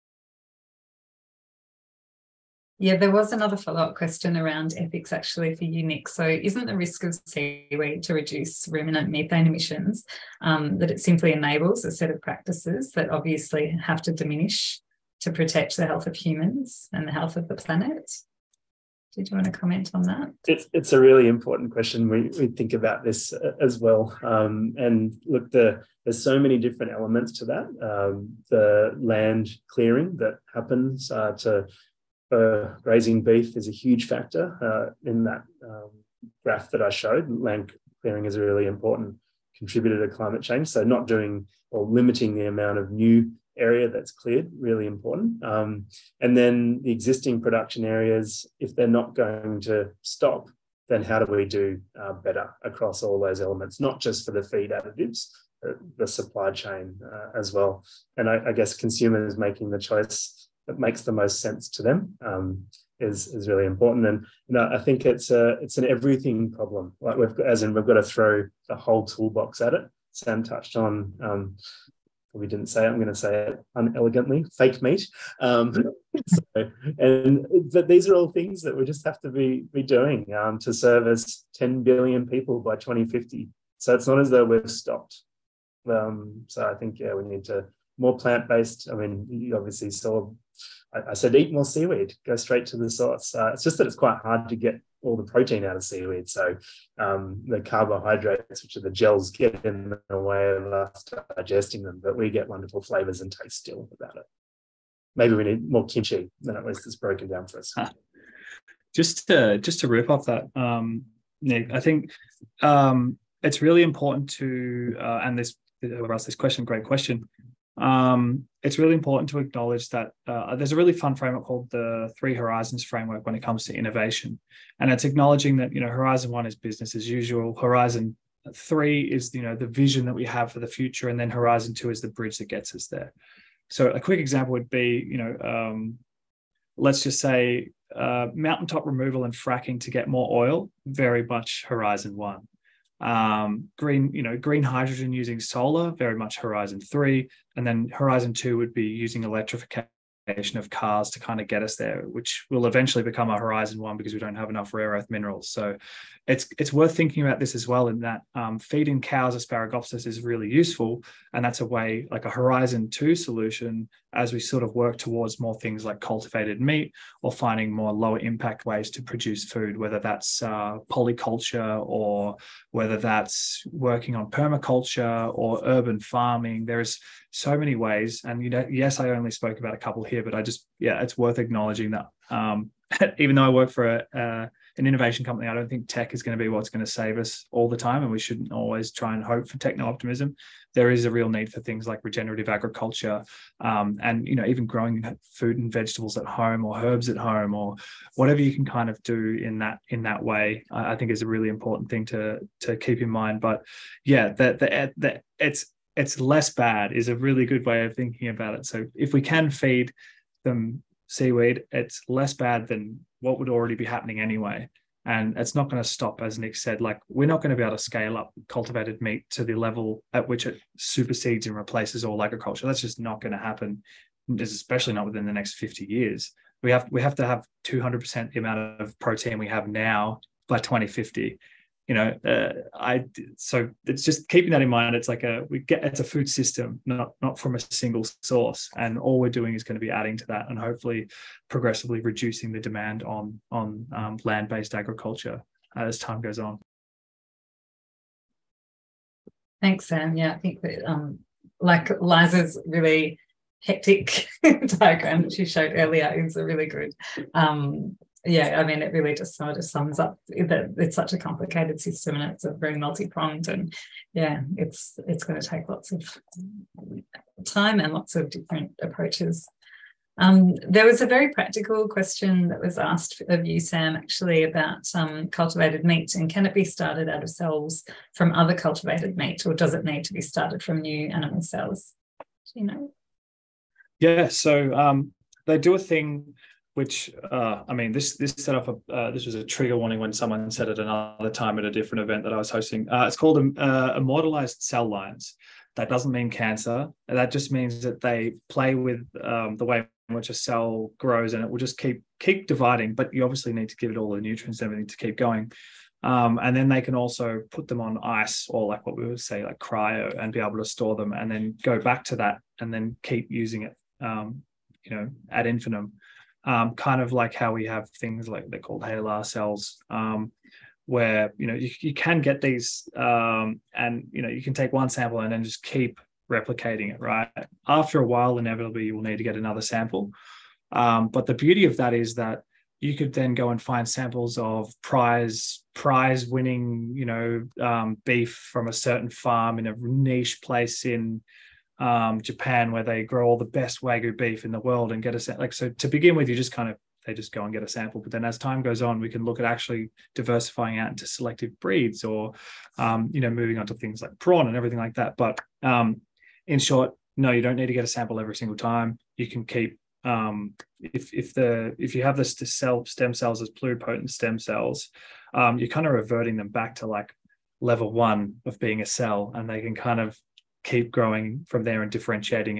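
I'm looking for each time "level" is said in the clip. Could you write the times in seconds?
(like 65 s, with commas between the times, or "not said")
219 s, 367 s.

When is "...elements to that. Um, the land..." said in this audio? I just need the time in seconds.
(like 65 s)
26 s.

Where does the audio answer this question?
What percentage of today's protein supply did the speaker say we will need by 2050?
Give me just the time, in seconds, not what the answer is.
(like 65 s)
227 s.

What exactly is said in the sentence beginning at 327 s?
Right after a while, inevitably you will need to get another sample.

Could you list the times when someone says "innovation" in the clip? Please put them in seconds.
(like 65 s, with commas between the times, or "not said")
123 s, 184 s.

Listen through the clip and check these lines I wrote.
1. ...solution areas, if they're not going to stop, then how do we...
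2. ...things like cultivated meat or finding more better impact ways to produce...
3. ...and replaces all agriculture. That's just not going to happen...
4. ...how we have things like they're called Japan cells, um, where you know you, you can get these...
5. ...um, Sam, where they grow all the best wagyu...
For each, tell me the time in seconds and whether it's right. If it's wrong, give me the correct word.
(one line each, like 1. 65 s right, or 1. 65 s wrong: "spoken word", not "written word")
1. 47 s wrong: "production", not "solution"
2. 165 s wrong: "lower", not "better"
3. 221 s right
4. 317 s wrong: "HeLa", not "Japan"
5. 341 s wrong: "Japan", not "Sam".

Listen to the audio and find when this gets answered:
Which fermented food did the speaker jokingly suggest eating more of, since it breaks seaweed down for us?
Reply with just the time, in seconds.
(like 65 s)
105 s.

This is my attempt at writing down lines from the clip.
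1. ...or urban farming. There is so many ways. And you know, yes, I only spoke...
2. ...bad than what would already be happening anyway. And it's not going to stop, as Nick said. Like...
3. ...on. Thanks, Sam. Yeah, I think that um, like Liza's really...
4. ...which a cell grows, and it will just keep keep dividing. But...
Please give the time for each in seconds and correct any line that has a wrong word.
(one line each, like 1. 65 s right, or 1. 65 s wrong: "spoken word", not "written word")
1. 175 s right
2. 212 s right
3. 246 s right
4. 300 s right.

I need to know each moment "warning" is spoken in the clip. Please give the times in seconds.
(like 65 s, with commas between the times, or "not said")
289 s.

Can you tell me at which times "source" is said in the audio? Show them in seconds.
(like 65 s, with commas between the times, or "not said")
92 s, 238 s.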